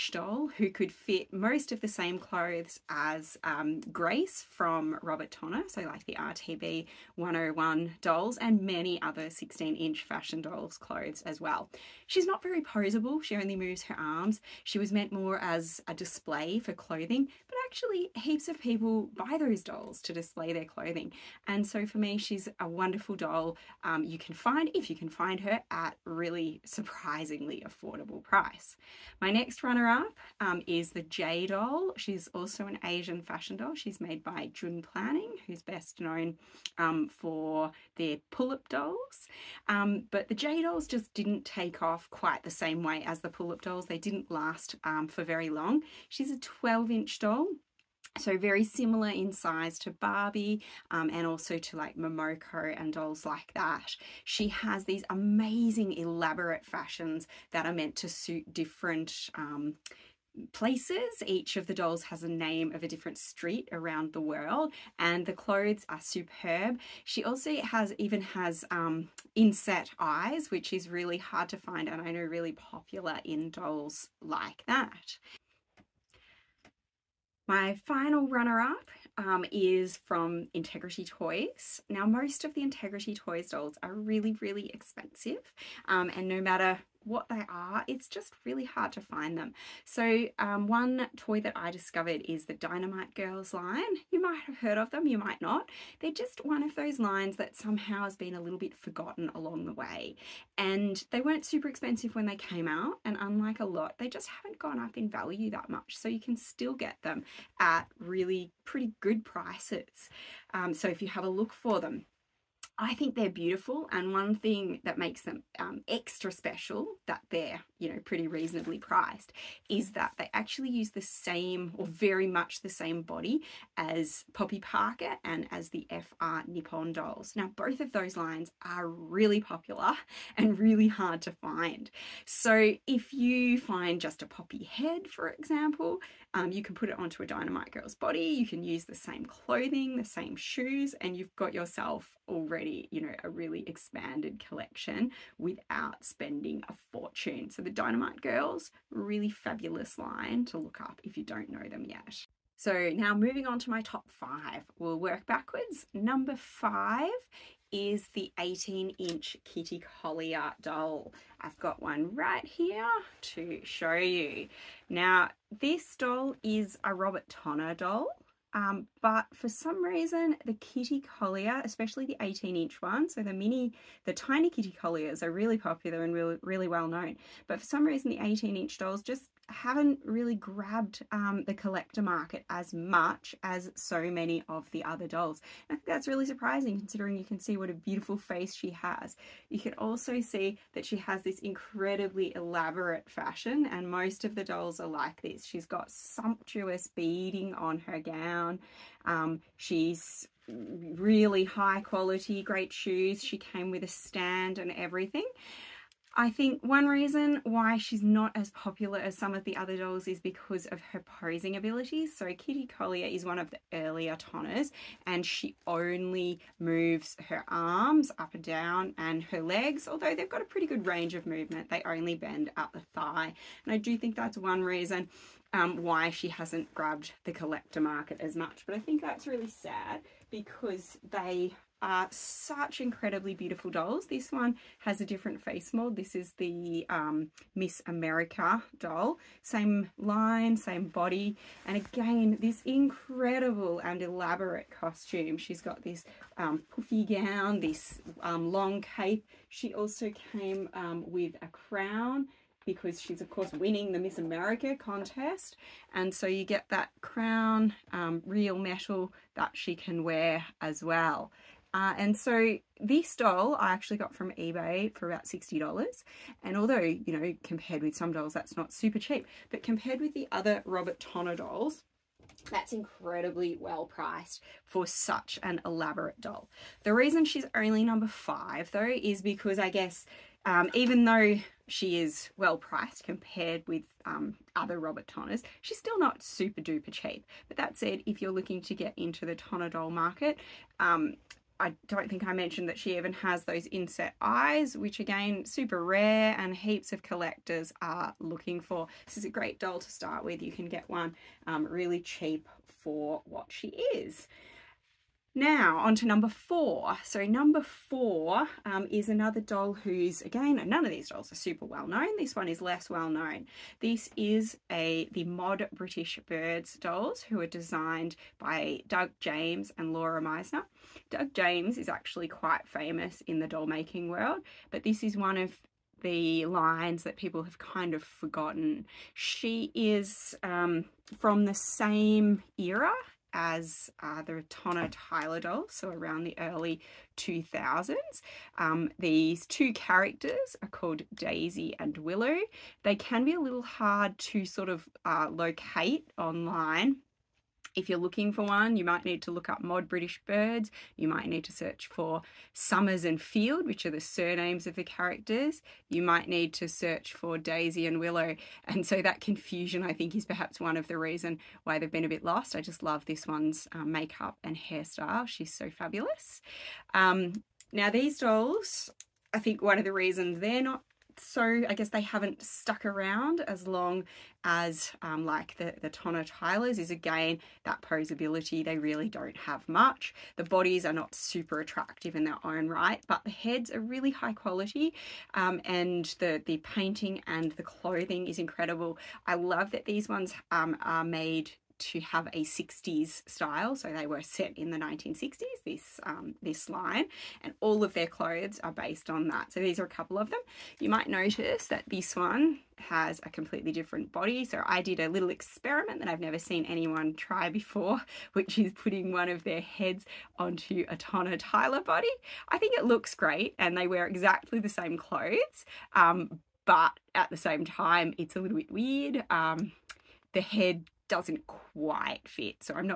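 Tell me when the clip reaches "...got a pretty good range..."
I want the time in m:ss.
3:40.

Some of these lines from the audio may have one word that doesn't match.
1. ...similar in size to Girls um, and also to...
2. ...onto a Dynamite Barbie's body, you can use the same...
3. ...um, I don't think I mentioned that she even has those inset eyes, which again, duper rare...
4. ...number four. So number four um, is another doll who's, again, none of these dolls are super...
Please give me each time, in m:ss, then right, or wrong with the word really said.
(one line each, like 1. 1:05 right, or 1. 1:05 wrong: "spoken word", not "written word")
1. 0:48 wrong: "Barbie", not "Girls"
2. 2:16 wrong: "Girl", not "Barbie"
3. 4:50 wrong: "super", not "duper"
4. 5:06 right.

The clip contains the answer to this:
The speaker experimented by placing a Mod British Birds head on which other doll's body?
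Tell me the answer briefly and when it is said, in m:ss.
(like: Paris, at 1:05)
Tonner Tyler, at 6:50.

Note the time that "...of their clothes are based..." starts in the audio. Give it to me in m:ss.
6:37.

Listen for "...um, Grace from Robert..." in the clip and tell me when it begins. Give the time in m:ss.
0:03.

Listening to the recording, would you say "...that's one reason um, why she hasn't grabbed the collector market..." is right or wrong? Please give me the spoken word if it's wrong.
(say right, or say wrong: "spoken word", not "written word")
right.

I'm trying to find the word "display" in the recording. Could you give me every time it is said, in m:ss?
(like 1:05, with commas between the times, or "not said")
0:15, 0:20.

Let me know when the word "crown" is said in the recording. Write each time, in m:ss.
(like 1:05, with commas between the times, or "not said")
4:11, 4:17.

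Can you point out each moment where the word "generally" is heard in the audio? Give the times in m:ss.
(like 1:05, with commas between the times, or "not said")
not said.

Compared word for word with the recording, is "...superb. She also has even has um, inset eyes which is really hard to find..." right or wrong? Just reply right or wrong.
right.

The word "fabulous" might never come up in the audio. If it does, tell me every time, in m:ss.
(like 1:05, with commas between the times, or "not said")
2:29, 6:05.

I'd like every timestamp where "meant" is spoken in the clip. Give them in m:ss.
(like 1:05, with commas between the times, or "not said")
0:14, 0:57.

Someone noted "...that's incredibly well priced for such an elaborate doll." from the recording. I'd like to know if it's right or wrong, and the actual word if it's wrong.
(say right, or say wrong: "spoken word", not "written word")
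right.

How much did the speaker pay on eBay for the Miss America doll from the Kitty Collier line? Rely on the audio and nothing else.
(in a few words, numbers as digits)
$60.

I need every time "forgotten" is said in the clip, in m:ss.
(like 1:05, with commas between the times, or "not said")
1:38, 5:28.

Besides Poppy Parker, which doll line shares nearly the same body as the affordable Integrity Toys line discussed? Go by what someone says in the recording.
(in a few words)
FR Nippon.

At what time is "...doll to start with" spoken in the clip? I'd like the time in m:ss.
4:59.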